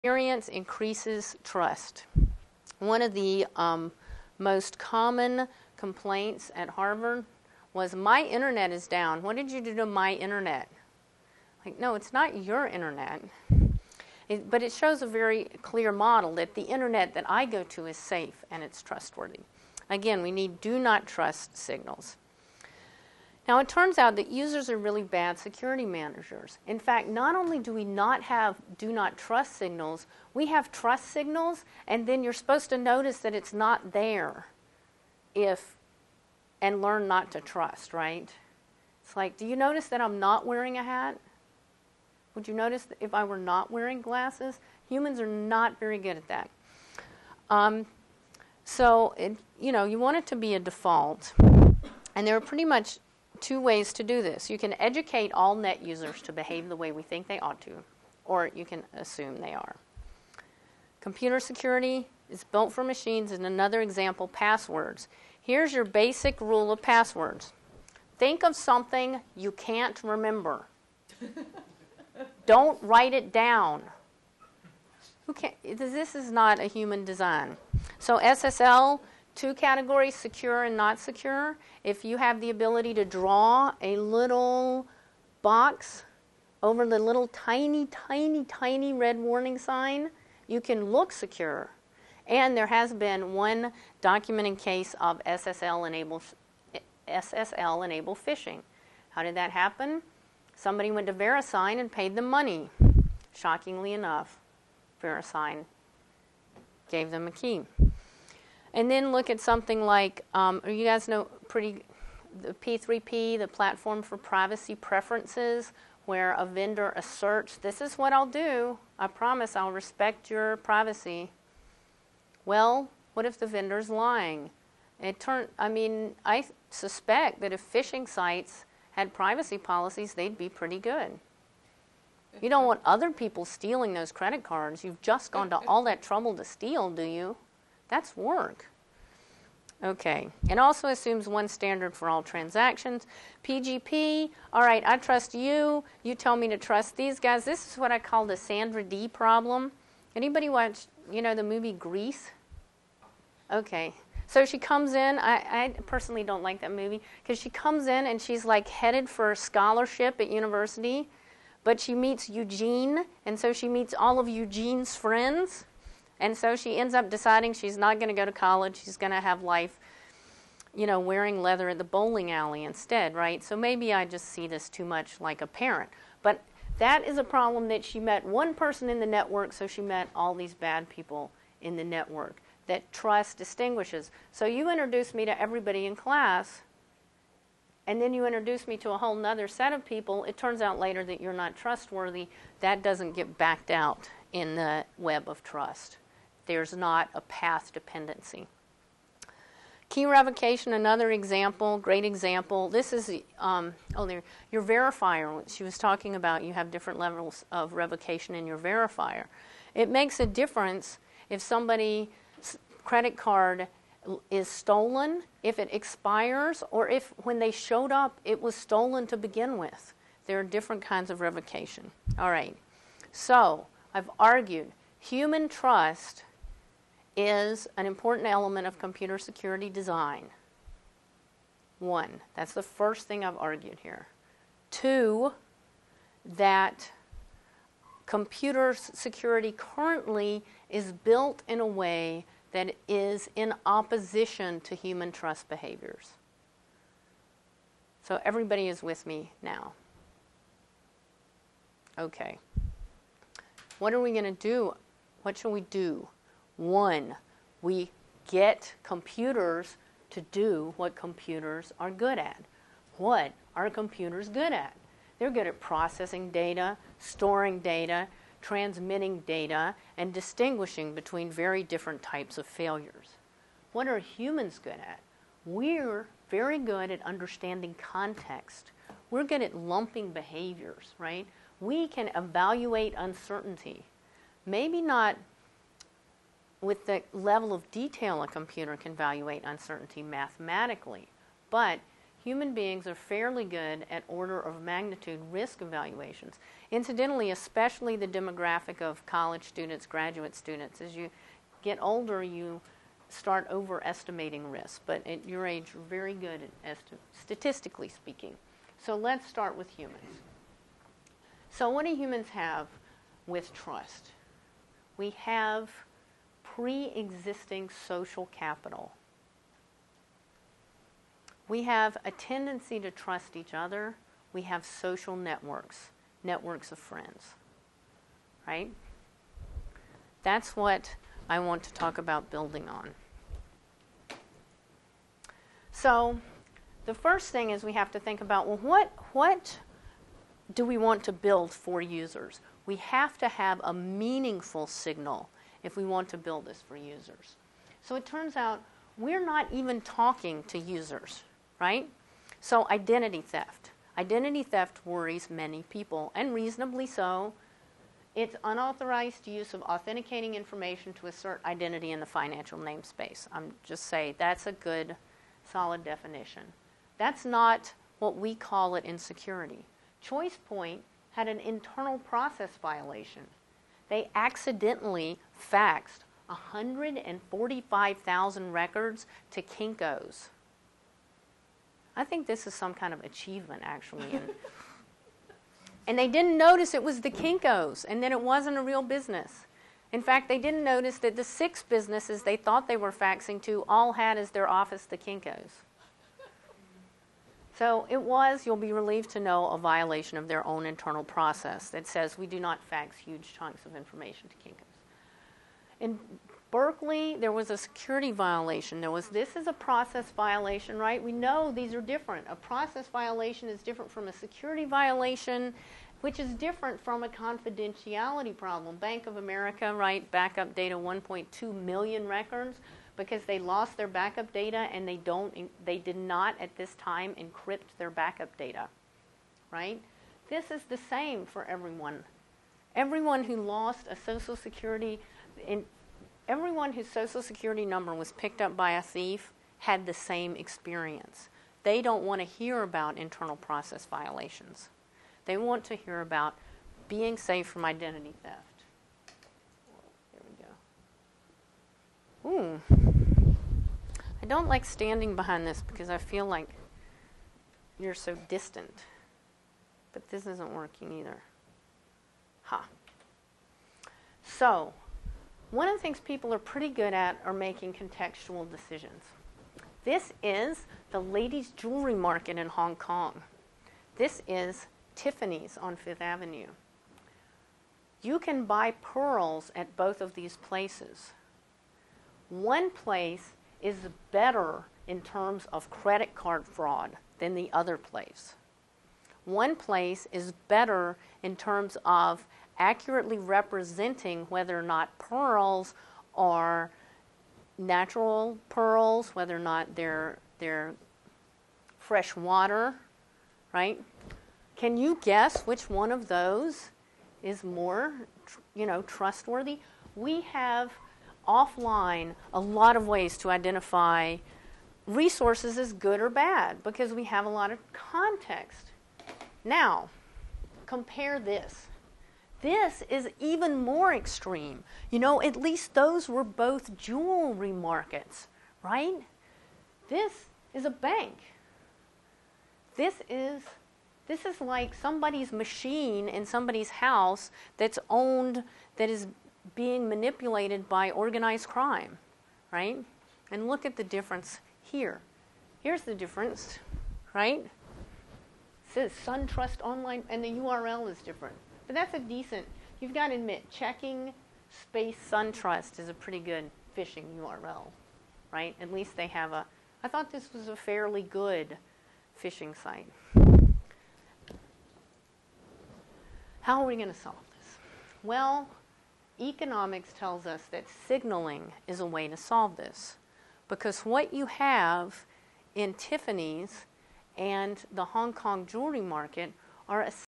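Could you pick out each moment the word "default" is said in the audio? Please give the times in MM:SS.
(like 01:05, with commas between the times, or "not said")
00:50.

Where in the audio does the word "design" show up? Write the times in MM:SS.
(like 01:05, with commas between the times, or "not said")
01:17, 03:49.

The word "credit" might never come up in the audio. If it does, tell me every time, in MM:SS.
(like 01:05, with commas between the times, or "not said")
02:14, 03:32, 08:05.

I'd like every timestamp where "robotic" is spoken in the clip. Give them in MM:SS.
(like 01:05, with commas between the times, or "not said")
not said.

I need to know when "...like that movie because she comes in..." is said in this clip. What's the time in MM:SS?
02:36.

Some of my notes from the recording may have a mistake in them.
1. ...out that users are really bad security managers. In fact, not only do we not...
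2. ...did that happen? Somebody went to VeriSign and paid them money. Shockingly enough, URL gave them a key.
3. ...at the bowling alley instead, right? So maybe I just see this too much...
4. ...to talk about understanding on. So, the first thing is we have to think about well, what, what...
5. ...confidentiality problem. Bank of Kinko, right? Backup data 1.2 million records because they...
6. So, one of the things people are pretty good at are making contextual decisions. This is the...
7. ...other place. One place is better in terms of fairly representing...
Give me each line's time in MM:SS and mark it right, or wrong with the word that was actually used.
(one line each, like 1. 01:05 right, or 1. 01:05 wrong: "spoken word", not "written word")
1. 00:23 right
2. 01:39 wrong: "VeriSign", not "URL"
3. 02:51 right
4. 05:31 wrong: "building", not "understanding"
5. 06:57 wrong: "America", not "Kinko"
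6. 07:44 right
7. 08:07 wrong: "accurately", not "fairly".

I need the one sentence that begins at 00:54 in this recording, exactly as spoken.
You can educate all net users to behave the way we think they ought to, or you can assume they are.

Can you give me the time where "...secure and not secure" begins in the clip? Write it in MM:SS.
01:20.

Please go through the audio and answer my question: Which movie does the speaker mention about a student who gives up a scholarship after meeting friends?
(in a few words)
Grease.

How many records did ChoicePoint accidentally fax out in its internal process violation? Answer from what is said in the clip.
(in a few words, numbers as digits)
145,000.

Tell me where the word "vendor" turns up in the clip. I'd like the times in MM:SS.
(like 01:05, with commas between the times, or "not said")
01:56, 02:03.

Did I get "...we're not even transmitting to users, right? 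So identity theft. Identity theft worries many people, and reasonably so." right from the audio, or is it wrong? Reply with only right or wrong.
wrong.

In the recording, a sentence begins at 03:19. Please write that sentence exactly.
Key revocation, another example, great example.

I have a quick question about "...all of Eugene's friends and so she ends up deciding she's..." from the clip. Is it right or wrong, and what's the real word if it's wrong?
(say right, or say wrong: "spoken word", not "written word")
right.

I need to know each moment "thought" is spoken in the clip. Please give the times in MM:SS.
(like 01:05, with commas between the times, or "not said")
06:32, 09:19.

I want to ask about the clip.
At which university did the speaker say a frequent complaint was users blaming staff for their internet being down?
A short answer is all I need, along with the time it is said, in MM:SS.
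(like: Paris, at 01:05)
Harvard, at 00:06.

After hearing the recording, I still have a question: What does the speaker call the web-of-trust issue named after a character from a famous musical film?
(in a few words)
Sandra Dee problem.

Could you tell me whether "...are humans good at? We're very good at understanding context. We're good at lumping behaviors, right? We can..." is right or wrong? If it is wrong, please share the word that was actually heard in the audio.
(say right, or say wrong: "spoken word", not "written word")
right.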